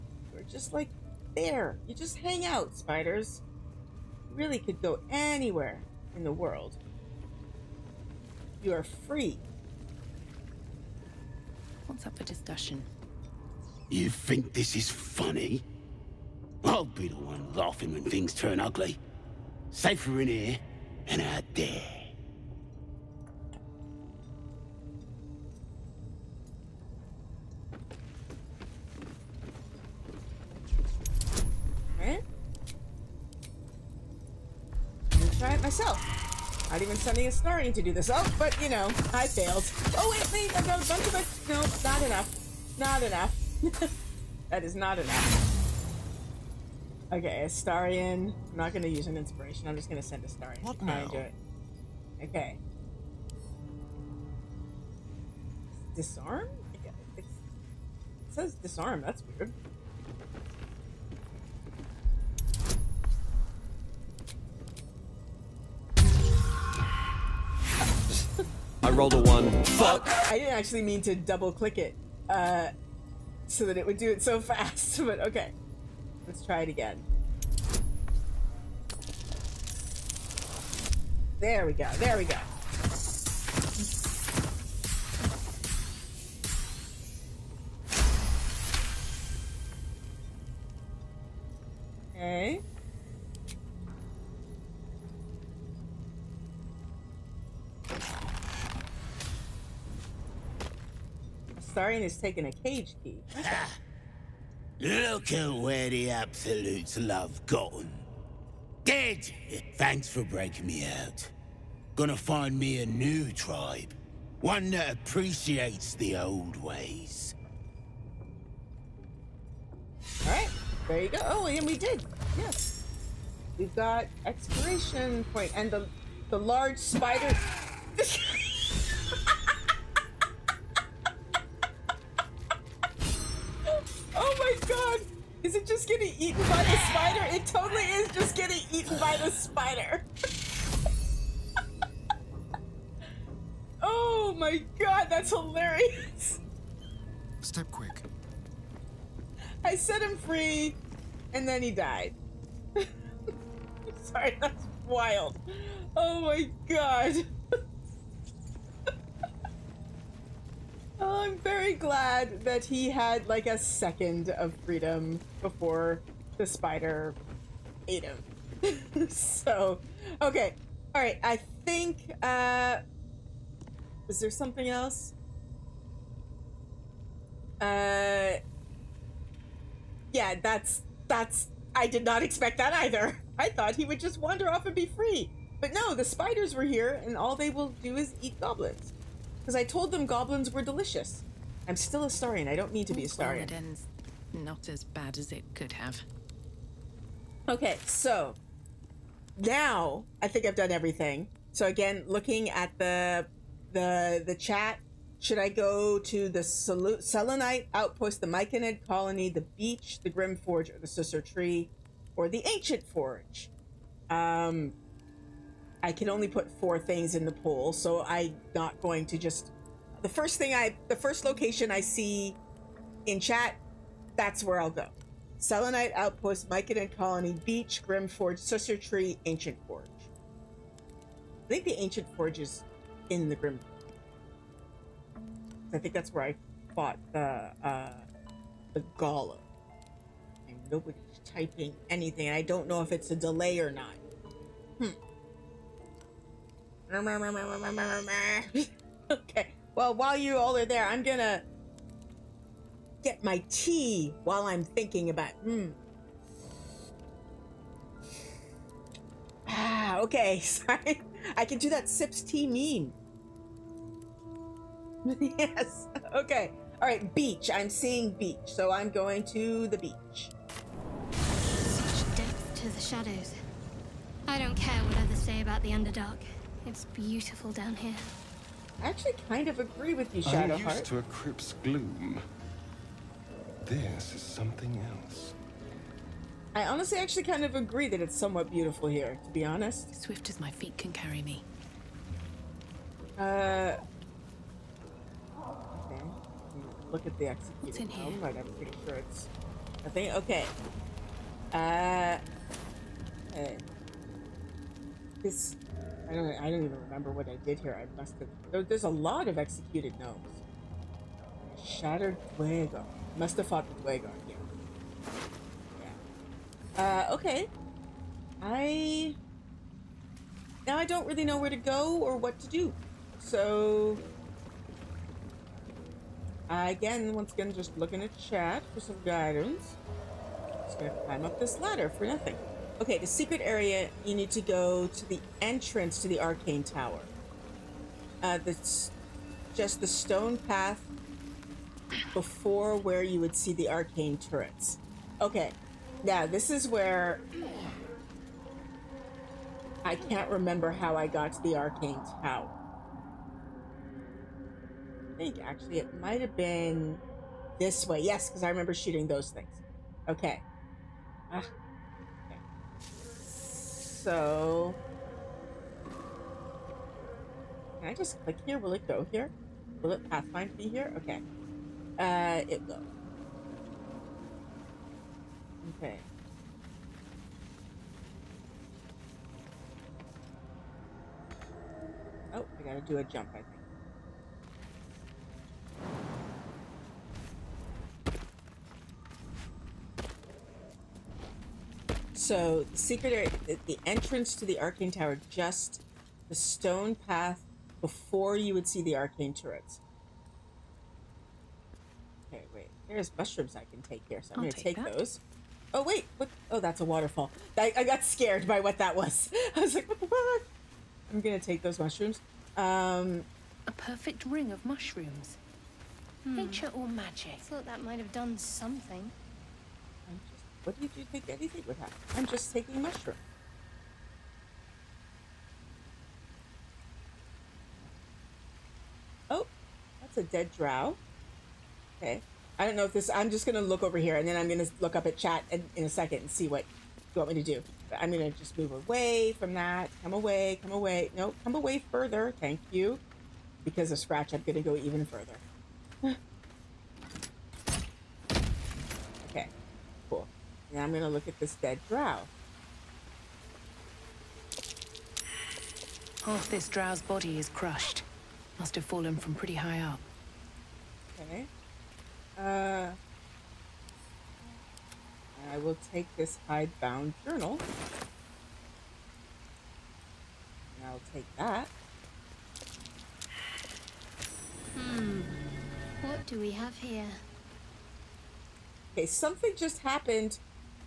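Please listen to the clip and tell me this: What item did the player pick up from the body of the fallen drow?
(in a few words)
hidebound journal.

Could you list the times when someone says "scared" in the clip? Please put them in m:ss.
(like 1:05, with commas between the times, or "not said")
6:48.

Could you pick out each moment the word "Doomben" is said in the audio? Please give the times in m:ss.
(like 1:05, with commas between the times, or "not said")
not said.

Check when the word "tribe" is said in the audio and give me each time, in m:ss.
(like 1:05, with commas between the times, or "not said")
1:53.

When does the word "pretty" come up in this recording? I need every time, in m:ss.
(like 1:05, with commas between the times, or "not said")
4:58, 7:39.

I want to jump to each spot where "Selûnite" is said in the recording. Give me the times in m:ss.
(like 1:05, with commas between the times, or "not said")
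3:26, 3:45.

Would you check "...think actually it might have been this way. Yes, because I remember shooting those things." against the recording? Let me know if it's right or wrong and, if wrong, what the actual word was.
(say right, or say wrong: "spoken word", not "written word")
right.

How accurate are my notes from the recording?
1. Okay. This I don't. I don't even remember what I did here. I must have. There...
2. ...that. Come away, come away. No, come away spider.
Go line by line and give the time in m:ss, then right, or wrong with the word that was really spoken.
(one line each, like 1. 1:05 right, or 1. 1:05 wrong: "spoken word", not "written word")
1. 5:03 right
2. 7:19 wrong: "further", not "spider".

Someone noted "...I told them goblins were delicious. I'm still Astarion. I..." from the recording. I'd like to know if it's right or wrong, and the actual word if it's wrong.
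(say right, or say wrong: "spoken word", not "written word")
right.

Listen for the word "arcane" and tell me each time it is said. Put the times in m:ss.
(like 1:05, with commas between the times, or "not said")
5:36, 5:43, 5:51, 6:34, 6:38.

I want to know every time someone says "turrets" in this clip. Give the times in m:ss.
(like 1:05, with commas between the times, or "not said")
5:44, 6:39.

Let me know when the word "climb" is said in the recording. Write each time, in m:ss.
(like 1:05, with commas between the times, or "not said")
5:31.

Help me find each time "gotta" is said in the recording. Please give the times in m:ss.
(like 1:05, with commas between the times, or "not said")
6:22.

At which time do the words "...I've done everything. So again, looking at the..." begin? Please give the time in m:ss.
3:20.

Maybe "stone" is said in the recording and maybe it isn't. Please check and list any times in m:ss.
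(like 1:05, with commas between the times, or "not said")
5:39, 6:36.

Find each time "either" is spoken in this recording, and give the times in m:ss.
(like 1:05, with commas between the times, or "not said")
3:02.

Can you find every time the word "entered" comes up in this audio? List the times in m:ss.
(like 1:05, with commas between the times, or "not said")
not said.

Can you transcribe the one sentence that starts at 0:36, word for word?
Not even sending a starting to do this.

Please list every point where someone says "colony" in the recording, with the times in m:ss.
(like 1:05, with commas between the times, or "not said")
3:28, 3:46.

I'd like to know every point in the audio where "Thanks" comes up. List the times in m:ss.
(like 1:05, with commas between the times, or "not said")
1:49, 7:22.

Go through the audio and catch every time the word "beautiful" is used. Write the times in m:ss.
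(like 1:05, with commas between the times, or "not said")
4:36, 4:48.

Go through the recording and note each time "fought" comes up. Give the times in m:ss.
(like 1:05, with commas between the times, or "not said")
3:56, 5:13.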